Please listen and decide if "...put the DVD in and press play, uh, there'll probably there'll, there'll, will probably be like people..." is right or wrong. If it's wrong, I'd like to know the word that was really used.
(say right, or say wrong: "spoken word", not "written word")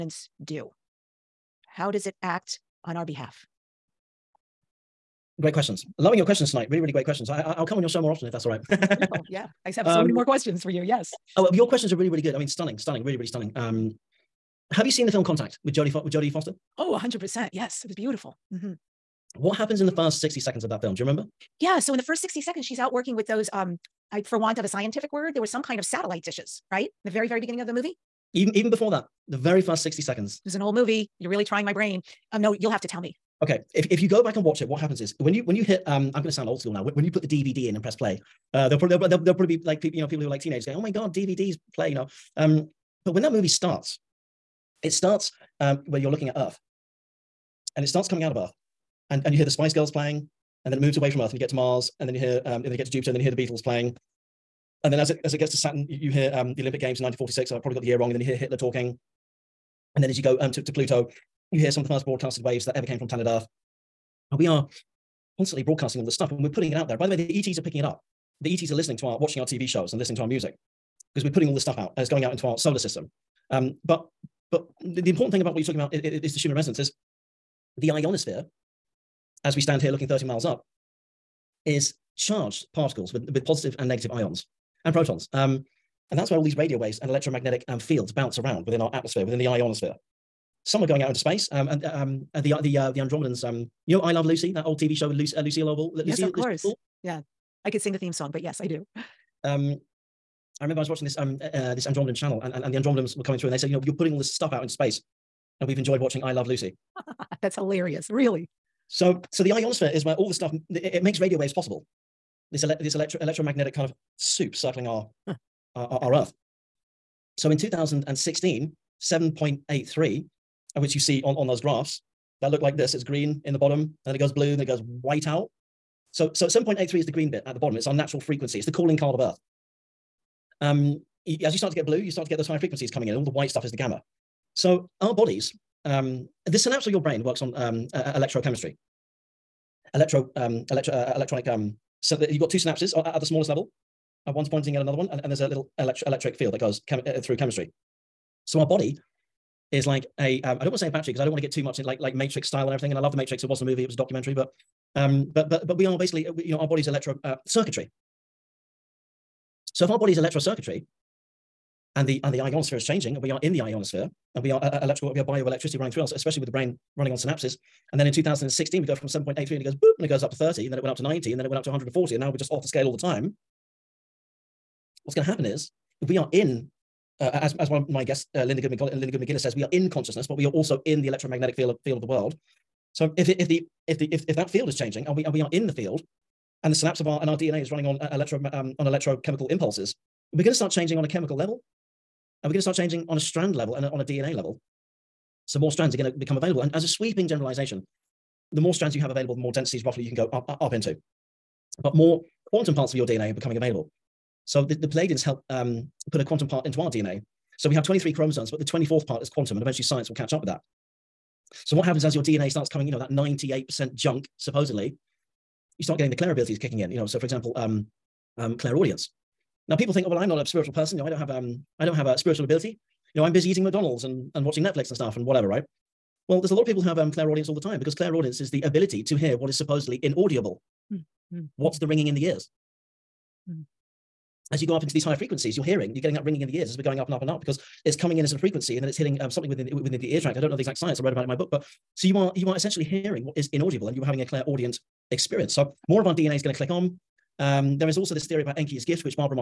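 right.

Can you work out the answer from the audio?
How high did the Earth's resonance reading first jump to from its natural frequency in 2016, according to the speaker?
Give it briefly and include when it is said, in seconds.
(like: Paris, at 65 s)
30, at 170 s.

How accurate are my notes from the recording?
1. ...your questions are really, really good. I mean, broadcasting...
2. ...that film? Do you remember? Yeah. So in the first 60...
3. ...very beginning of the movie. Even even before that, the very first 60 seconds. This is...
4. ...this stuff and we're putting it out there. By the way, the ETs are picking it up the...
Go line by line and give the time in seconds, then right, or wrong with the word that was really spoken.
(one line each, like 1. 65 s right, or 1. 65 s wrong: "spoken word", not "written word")
1. 11 s wrong: "stunning", not "broadcasting"
2. 20 s right
3. 27 s right
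4. 66 s right.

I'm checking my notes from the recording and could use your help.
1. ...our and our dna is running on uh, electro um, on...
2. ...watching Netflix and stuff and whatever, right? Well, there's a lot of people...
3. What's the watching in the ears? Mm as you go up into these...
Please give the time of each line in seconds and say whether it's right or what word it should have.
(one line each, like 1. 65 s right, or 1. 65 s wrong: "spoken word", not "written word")
1. 187 s right
2. 224 s right
3. 231 s wrong: "ringing", not "watching".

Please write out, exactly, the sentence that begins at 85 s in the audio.
Um, and that's where all these radio waves and electromagnetic um, fields bounce around within our atmosphere, within the ionosphere.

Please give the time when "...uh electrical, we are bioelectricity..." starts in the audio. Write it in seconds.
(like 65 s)
164 s.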